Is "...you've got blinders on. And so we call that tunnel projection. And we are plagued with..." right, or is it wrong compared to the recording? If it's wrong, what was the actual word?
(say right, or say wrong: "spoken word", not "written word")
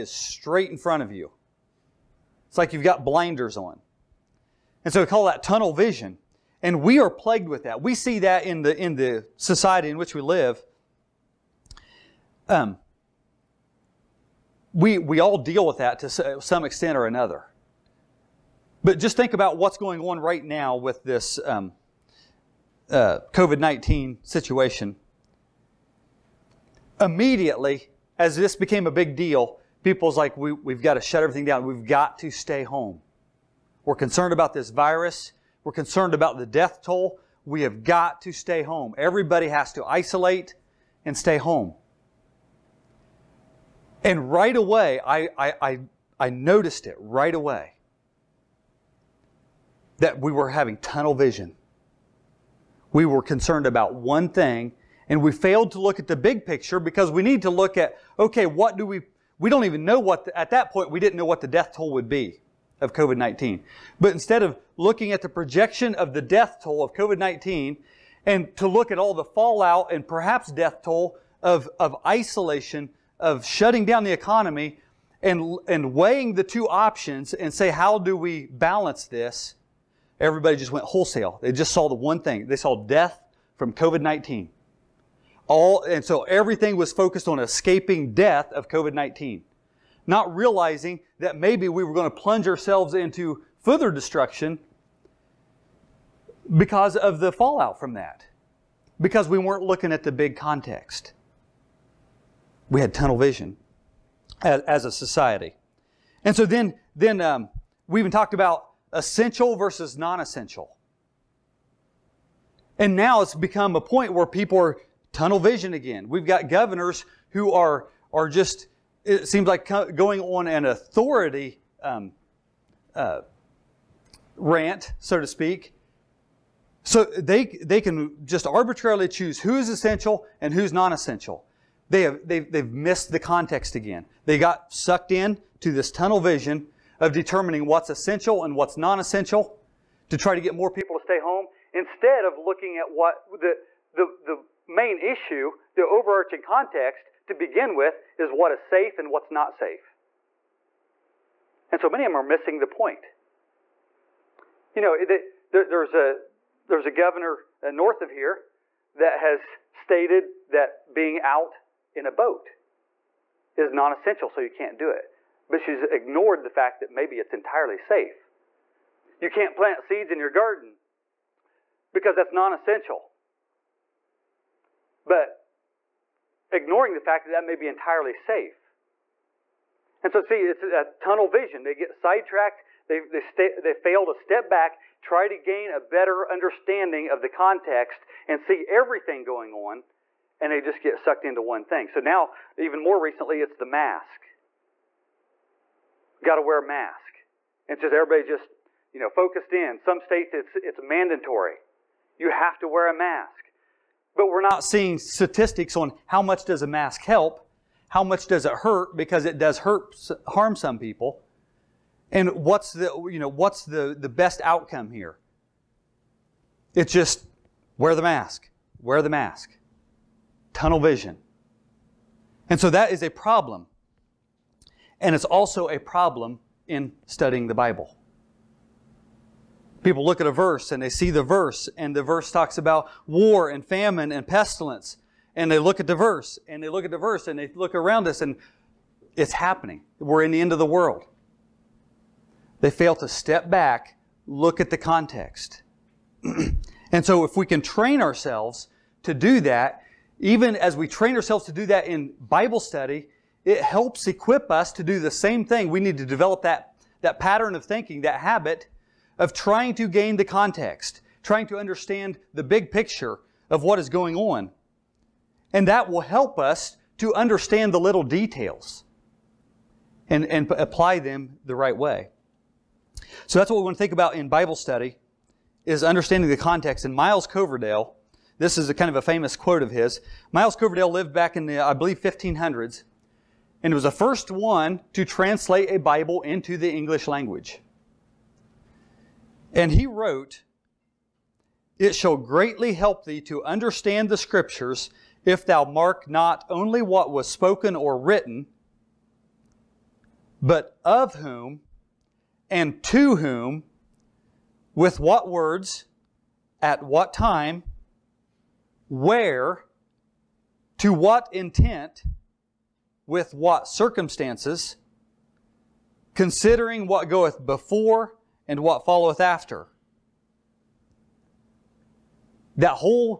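wrong: "vision", not "projection".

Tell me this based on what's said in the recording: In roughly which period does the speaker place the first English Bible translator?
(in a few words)
1500s.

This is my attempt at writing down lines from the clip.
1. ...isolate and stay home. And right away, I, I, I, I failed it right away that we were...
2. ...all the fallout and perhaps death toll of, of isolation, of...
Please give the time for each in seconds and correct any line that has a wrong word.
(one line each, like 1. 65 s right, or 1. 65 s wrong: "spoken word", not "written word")
1. 39 s wrong: "noticed", not "failed"
2. 68 s right.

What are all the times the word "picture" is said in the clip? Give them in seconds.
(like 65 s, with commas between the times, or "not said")
56 s, 262 s.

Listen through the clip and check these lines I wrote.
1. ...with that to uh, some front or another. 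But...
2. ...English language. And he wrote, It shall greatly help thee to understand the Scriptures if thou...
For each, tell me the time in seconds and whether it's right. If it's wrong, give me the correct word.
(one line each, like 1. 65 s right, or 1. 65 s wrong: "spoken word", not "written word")
1. 15 s wrong: "extent", not "front"
2. 286 s right.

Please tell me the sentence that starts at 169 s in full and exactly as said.
You can't plant seeds in your garden because that's non essential.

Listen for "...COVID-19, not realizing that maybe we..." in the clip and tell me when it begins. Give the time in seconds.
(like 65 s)
88 s.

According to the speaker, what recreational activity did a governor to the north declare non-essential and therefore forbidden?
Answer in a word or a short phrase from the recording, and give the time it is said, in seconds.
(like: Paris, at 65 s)
Being out in a boat, at 160 s.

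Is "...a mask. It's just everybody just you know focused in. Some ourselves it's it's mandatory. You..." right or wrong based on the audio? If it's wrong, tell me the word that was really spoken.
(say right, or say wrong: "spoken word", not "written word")
wrong: "states", not "ourselves".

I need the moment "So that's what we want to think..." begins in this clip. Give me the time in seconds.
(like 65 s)
273 s.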